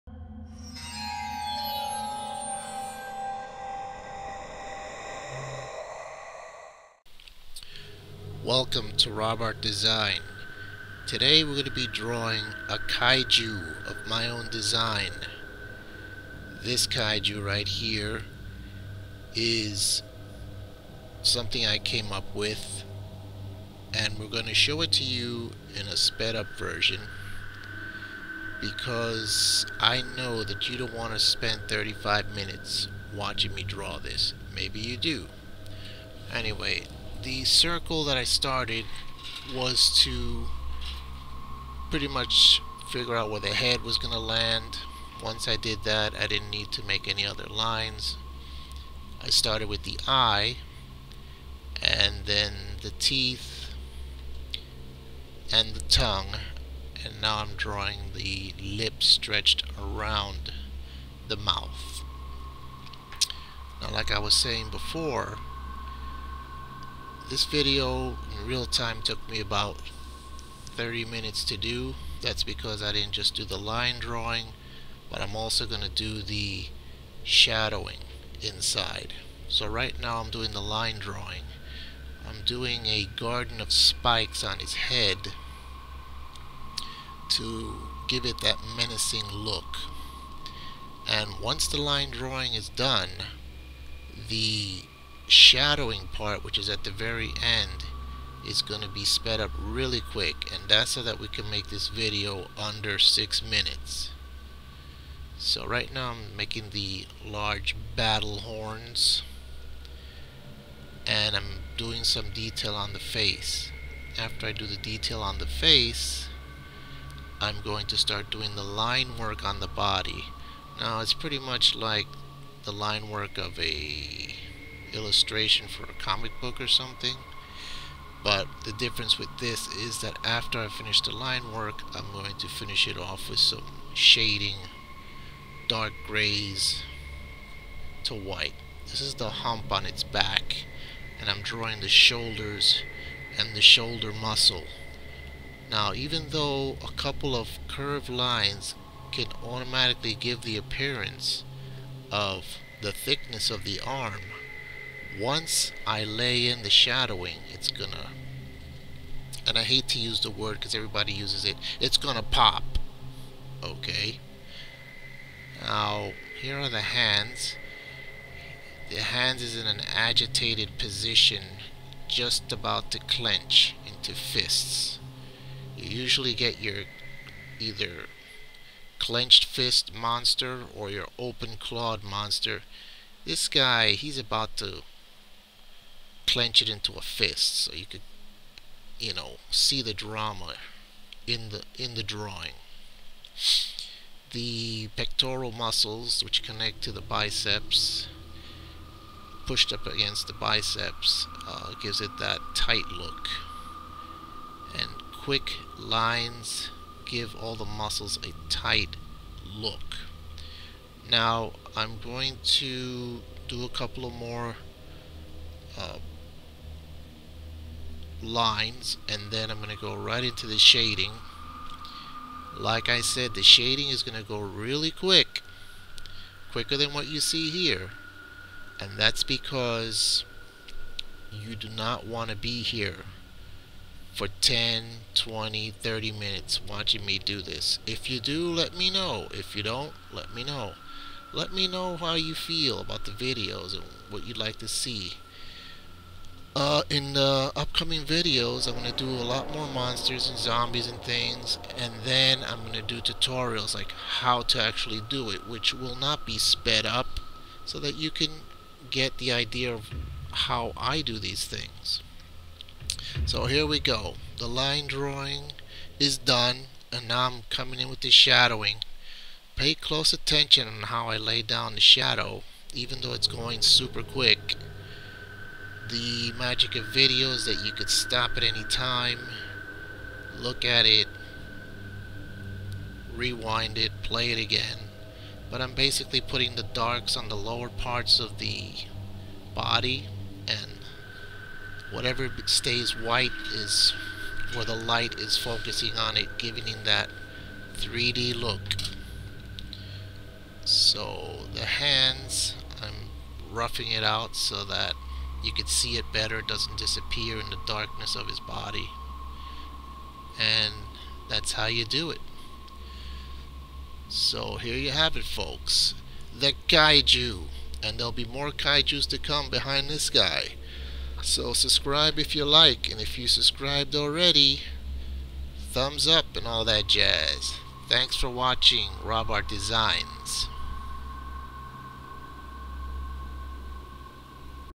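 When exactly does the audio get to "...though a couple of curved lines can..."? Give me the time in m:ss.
2:26.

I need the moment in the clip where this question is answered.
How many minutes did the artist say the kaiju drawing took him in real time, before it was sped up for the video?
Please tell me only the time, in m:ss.
0:31.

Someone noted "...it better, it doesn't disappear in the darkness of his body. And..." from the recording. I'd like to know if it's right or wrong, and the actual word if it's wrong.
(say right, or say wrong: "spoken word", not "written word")
right.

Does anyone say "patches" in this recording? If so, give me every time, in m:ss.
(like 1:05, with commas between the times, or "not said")
not said.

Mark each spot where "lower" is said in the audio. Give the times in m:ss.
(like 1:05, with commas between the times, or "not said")
4:47.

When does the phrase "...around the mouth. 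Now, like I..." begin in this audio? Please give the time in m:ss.
0:59.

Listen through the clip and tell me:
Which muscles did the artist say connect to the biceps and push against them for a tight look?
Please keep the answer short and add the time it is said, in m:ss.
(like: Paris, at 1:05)
pectoral muscles, at 3:14.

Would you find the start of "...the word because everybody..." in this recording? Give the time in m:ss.
2:40.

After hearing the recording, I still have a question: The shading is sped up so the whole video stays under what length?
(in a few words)
6 minutes.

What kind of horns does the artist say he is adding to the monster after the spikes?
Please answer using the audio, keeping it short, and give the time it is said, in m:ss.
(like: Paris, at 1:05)
large battle horns, at 1:47.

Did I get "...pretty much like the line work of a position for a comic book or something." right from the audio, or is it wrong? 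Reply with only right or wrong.
wrong.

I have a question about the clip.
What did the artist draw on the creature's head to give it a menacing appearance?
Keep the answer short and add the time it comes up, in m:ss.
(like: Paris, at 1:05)
garden of spikes, at 1:23.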